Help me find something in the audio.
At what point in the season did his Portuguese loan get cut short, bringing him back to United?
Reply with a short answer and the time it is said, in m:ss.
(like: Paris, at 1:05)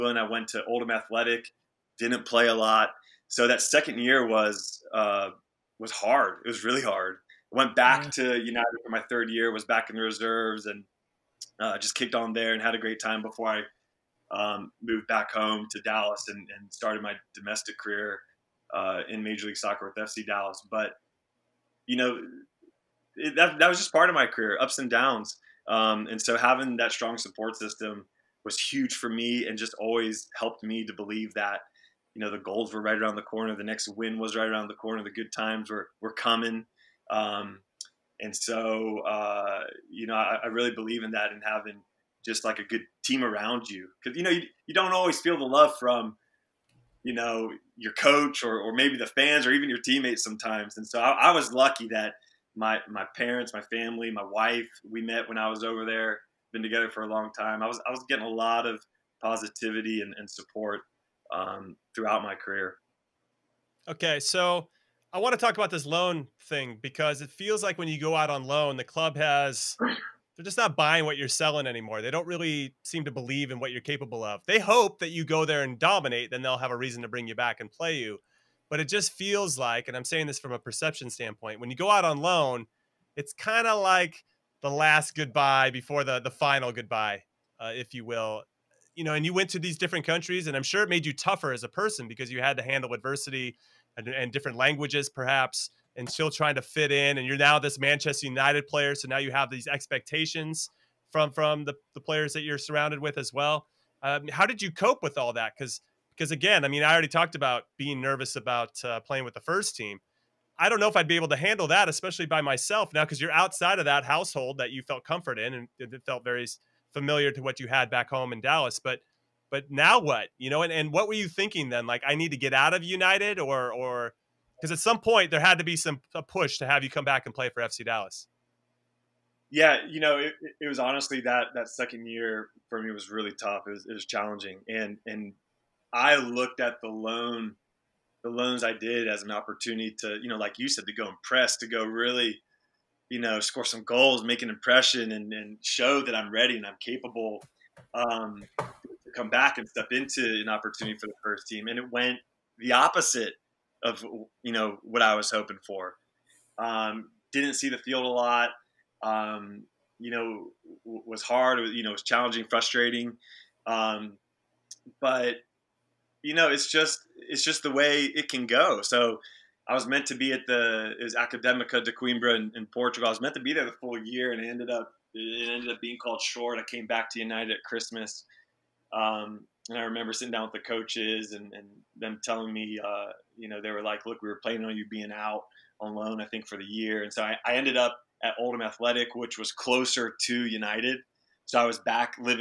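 Christmas, at 2:57.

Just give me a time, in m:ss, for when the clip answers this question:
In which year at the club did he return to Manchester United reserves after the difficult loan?
0:09.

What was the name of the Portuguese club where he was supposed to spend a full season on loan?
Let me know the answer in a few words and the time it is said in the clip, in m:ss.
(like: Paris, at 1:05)
Academica de Coimbra, at 2:51.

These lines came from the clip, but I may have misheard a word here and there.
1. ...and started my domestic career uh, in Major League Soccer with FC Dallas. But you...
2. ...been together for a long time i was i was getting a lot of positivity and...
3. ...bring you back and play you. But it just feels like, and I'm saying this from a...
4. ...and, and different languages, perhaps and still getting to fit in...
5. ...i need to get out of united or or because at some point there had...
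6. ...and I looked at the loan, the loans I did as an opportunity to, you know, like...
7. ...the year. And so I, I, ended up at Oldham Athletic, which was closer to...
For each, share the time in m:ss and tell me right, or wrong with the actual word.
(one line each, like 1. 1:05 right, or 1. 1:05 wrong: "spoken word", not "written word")
1. 0:16 right
2. 0:56 right
3. 1:17 right
4. 1:33 wrong: "trying", not "getting"
5. 2:02 right
6. 2:15 right
7. 3:06 right.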